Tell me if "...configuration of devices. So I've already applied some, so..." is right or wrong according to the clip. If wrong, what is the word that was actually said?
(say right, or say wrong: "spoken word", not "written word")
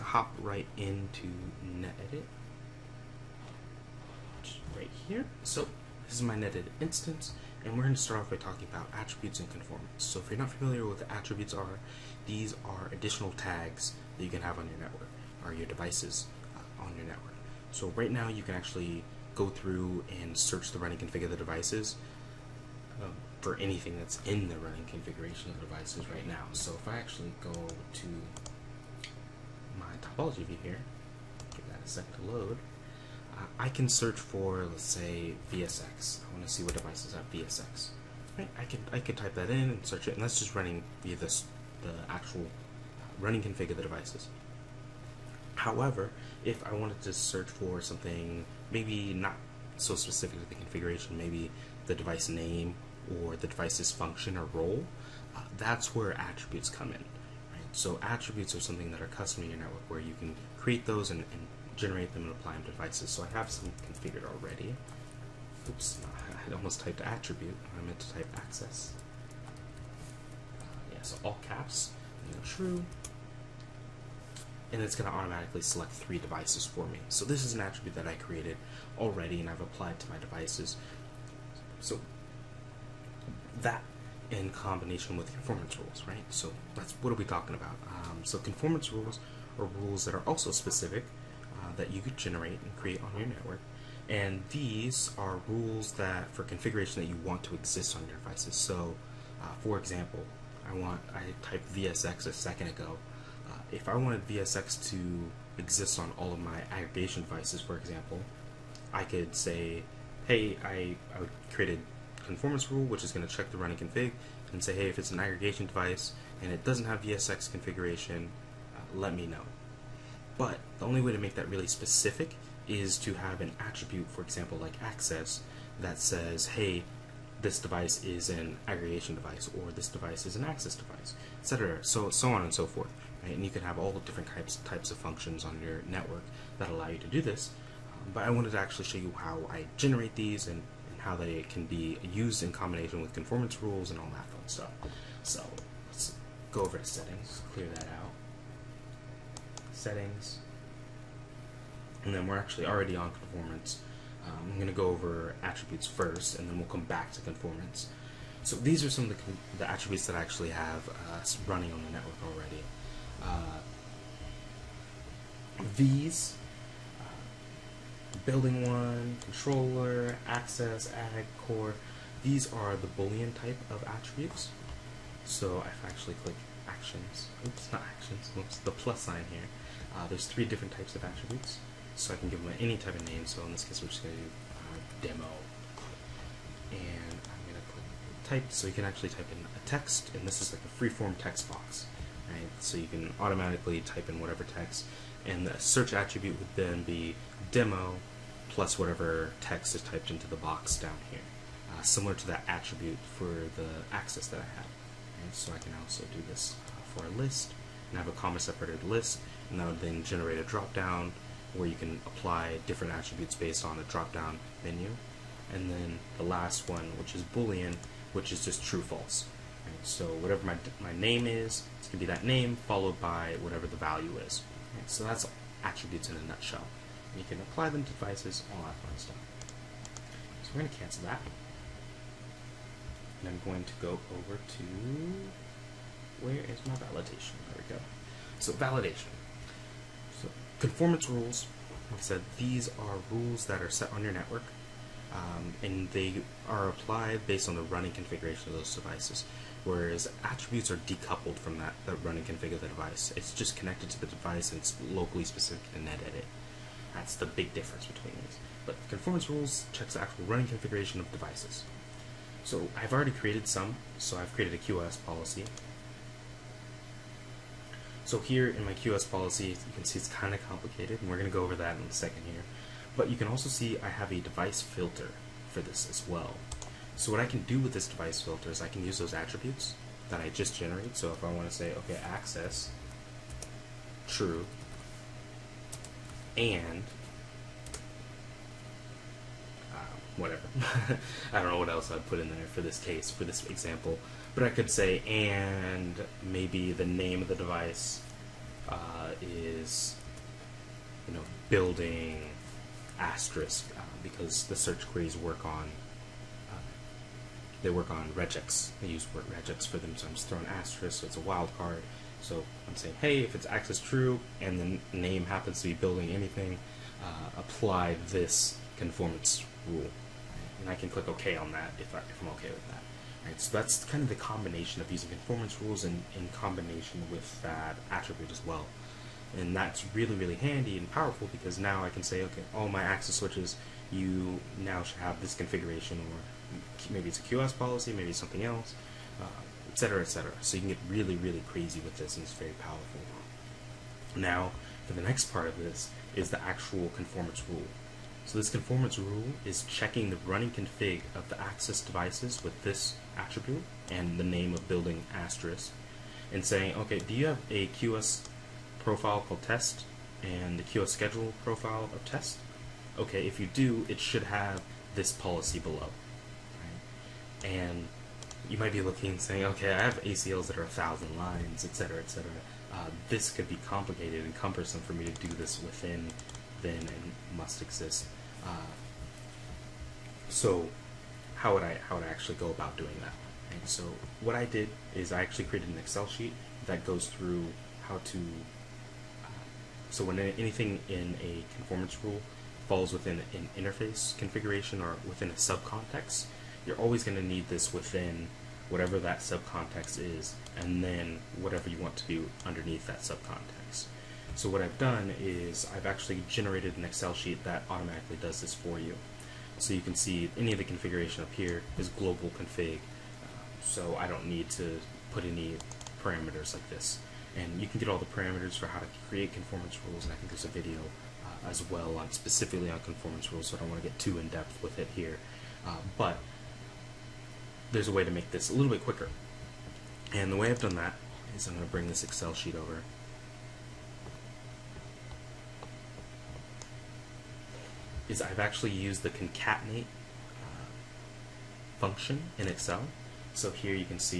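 wrong: "created", not "applied".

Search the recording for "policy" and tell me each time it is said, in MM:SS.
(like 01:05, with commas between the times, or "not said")
04:25, 04:29, 05:37, 06:05.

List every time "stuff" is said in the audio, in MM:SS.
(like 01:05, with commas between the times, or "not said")
02:24, 03:48.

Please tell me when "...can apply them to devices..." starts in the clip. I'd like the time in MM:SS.
03:47.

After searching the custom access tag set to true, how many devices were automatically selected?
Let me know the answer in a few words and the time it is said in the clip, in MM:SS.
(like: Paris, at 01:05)
3, at 01:15.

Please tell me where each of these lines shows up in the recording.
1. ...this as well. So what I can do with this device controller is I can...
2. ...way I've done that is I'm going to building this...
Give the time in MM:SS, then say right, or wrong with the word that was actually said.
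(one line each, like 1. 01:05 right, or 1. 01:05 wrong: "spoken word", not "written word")
1. 04:35 wrong: "filter", not "controller"
2. 07:10 wrong: "bring", not "building".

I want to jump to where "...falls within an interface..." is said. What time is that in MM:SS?
06:32.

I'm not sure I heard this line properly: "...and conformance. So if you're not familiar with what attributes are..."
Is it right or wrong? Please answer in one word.
right.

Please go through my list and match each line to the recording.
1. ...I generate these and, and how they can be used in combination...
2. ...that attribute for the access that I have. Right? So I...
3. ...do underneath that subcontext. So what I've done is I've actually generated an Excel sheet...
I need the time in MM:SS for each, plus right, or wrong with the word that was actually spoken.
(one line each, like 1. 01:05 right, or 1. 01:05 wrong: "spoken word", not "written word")
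1. 02:19 right
2. 03:22 right
3. 06:42 right.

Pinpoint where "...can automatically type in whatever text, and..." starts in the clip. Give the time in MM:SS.
03:12.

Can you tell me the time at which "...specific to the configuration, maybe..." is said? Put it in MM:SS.
00:49.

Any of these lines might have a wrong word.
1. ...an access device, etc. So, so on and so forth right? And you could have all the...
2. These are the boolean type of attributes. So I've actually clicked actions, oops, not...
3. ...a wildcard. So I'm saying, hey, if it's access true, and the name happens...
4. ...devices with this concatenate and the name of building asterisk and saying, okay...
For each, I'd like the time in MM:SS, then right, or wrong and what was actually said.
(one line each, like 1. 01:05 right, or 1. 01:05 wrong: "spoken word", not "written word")
1. 02:10 right
2. 02:52 right
3. 05:11 right
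4. 05:51 wrong: "attribute", not "concatenate".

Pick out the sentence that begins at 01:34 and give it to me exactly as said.
And these are rules that for configuration that you want to exist on your devices.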